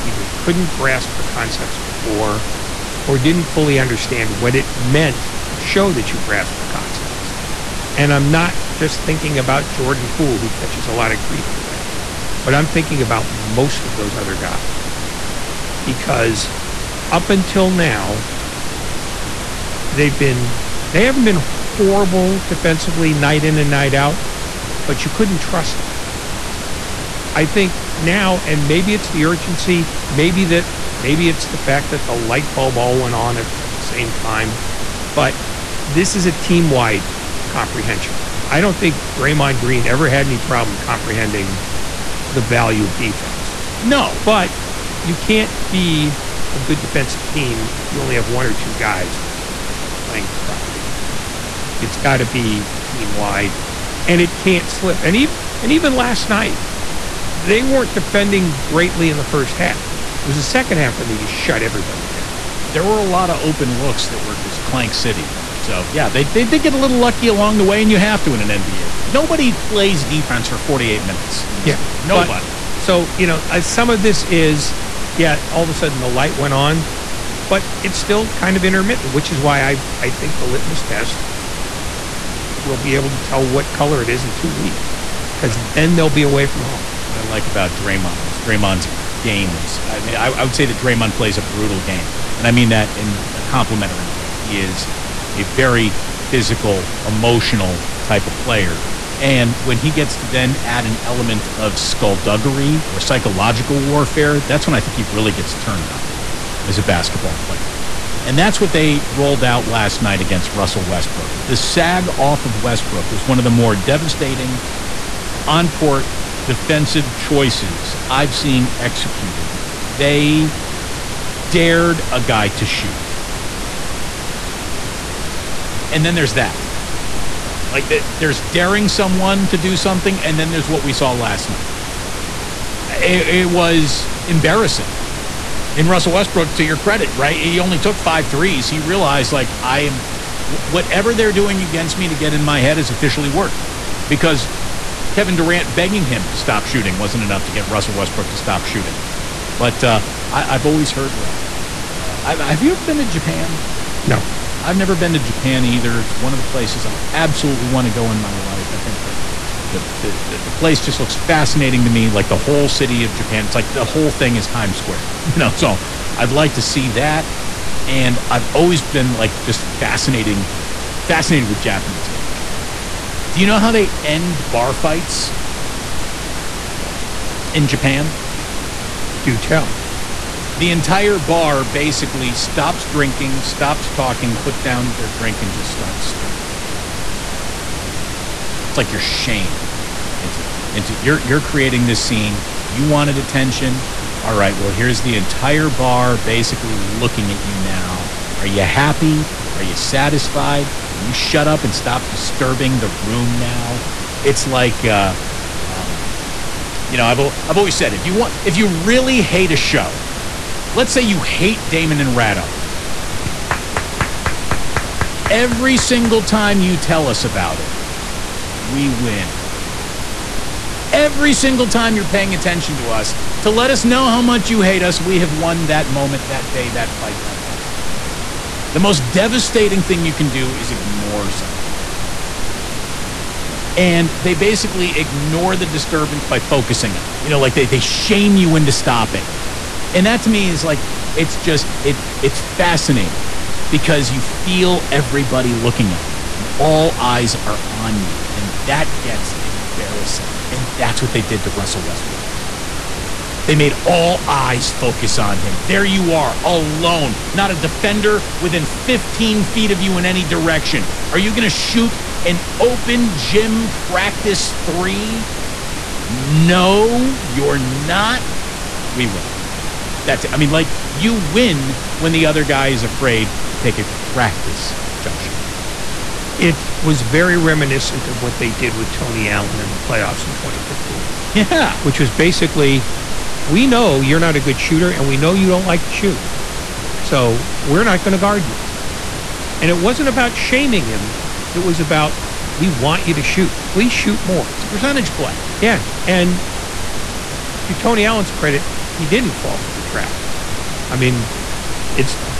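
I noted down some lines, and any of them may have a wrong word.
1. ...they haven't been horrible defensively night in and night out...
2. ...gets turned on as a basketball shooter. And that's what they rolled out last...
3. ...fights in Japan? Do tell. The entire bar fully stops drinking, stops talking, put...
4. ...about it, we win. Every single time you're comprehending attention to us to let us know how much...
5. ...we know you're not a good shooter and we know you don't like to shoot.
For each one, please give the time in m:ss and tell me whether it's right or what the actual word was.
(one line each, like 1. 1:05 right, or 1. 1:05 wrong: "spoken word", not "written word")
1. 0:20 right
2. 1:45 wrong: "player", not "shooter"
3. 2:54 wrong: "basically", not "fully"
4. 3:37 wrong: "paying", not "comprehending"
5. 4:43 right.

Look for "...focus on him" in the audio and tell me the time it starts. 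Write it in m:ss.
4:14.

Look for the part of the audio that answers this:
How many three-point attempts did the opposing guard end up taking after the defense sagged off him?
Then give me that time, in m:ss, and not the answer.
2:17.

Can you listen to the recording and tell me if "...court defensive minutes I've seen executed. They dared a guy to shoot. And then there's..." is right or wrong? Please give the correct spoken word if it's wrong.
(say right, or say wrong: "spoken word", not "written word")
wrong: "choices", not "minutes".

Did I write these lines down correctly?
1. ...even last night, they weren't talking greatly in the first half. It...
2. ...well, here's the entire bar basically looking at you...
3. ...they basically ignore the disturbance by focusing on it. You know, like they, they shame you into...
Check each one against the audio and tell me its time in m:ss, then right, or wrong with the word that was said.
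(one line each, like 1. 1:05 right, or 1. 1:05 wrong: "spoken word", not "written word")
1. 0:55 wrong: "defending", not "talking"
2. 3:14 right
3. 3:54 right.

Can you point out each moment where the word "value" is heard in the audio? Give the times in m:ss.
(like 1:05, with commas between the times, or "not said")
0:42.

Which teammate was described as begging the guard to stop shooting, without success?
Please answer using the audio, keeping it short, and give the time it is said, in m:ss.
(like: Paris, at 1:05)
Kevin Durant, at 2:25.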